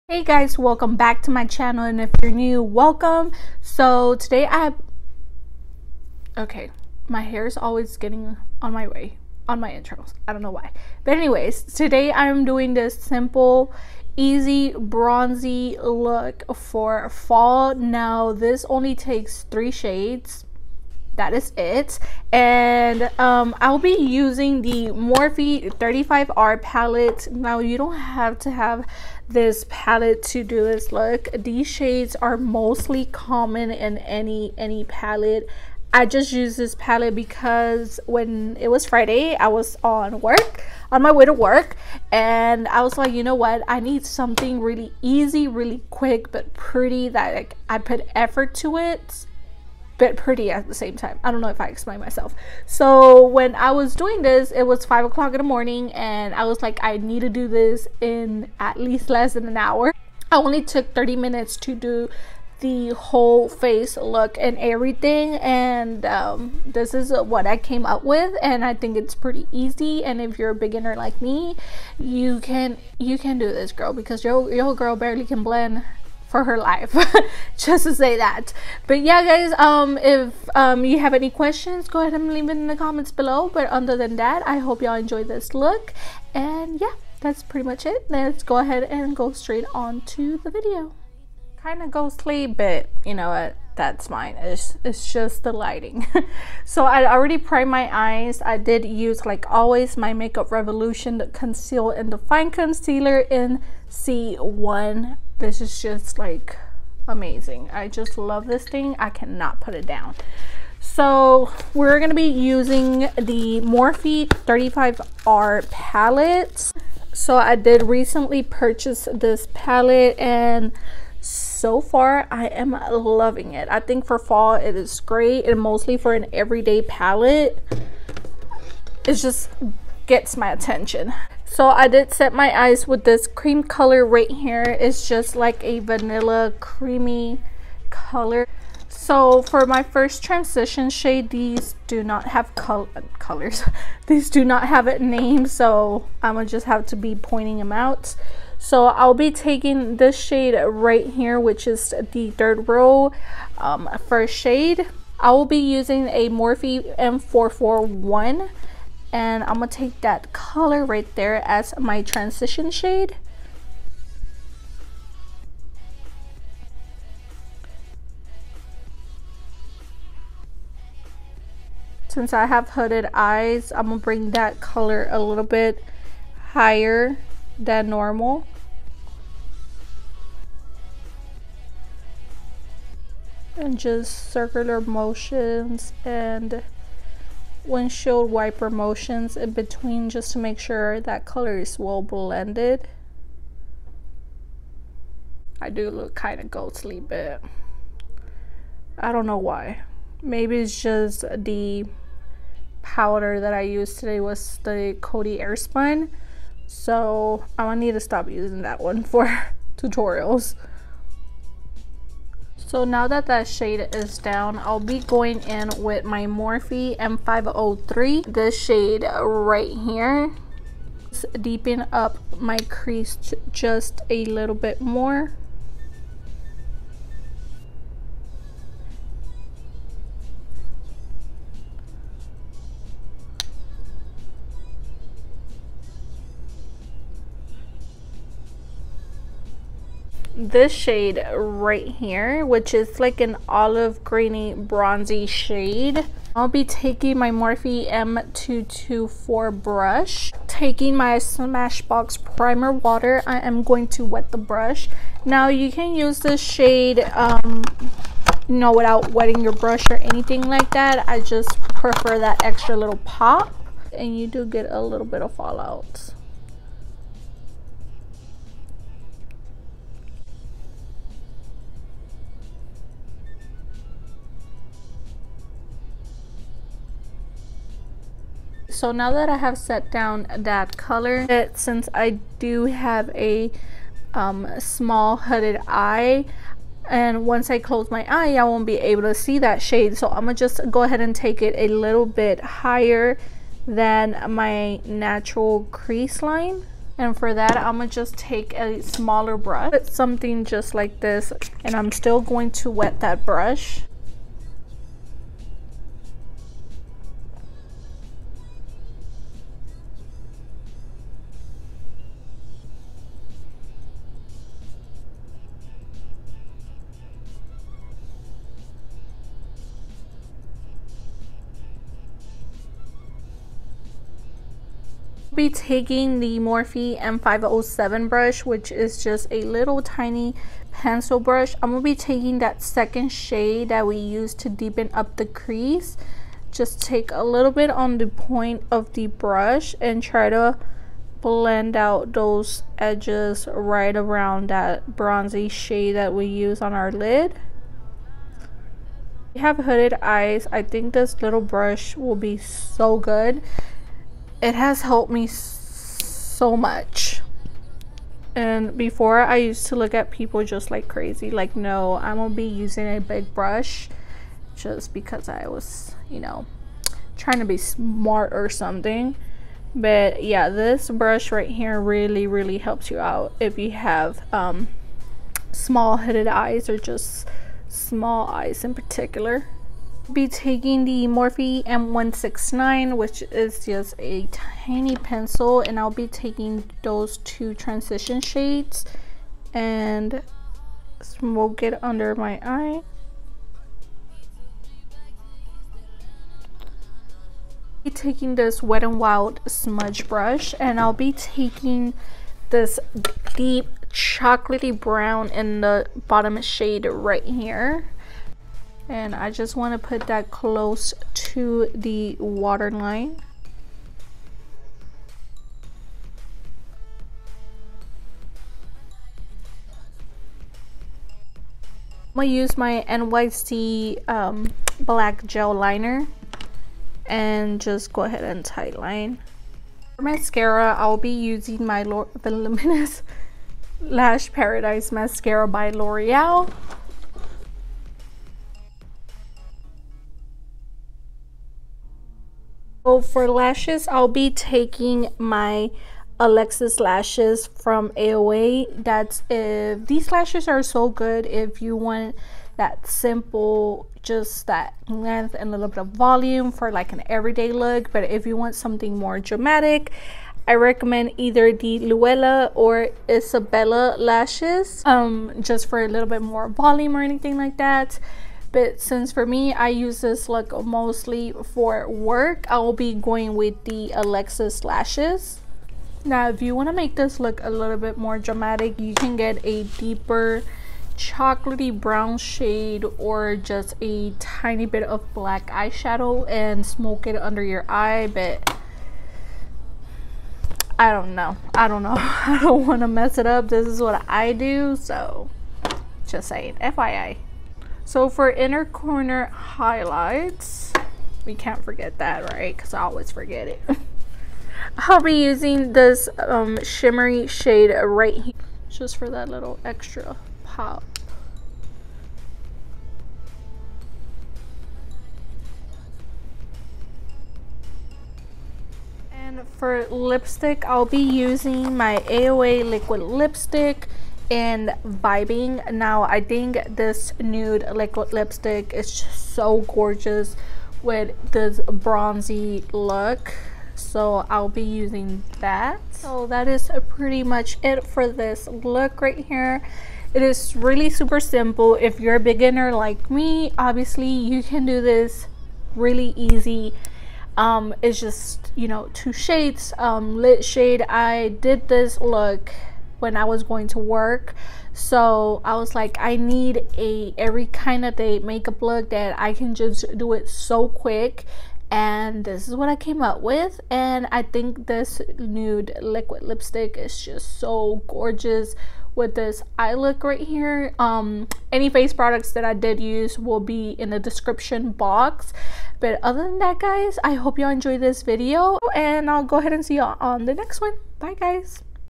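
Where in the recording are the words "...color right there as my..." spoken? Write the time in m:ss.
2:40.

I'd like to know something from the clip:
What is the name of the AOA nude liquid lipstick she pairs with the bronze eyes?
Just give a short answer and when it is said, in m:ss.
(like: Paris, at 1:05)
Vibin, at 8:44.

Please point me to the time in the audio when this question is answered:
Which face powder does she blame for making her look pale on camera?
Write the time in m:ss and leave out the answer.
3:25.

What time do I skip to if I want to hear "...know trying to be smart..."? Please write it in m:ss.
6:06.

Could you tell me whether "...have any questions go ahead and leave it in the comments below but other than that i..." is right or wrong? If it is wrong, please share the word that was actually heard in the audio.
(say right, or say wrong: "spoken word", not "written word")
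right.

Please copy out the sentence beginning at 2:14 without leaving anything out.
It's just like a vanilla creamy color.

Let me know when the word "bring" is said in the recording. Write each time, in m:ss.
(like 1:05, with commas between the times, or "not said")
2:53.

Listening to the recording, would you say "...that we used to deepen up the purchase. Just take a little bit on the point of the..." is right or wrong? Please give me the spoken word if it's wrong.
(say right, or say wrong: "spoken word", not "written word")
wrong: "crease", not "purchase".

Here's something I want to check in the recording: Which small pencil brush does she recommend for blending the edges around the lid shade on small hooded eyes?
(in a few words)
Morphe M507.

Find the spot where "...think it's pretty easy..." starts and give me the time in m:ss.
1:08.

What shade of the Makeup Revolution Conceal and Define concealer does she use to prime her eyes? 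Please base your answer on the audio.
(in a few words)
C1.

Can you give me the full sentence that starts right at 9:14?
So I was like, I need a every kind of day makeup look that I can just do it so quick.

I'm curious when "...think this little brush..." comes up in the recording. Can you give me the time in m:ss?
5:50.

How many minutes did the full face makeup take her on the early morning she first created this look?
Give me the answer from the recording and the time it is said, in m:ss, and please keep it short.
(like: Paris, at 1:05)
30, at 1:00.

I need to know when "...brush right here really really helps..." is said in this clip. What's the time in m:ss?
6:10.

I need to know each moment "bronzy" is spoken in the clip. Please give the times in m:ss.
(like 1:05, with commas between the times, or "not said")
0:14, 4:04, 5:44, 8:51.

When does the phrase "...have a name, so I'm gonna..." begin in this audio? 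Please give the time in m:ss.
2:24.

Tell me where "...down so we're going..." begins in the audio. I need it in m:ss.
1:49.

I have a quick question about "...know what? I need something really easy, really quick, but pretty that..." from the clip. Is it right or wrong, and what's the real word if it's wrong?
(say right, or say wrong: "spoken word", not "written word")
right.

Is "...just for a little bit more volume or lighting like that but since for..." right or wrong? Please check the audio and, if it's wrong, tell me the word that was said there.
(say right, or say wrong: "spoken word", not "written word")
wrong: "anything", not "lighting".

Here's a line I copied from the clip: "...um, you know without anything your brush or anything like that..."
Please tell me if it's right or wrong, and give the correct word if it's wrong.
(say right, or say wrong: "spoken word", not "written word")
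wrong: "wetting", not "anything".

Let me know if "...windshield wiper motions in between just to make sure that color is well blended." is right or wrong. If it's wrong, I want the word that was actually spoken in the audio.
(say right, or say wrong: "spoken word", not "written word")
right.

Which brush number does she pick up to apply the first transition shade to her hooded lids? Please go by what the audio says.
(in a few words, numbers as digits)
M441.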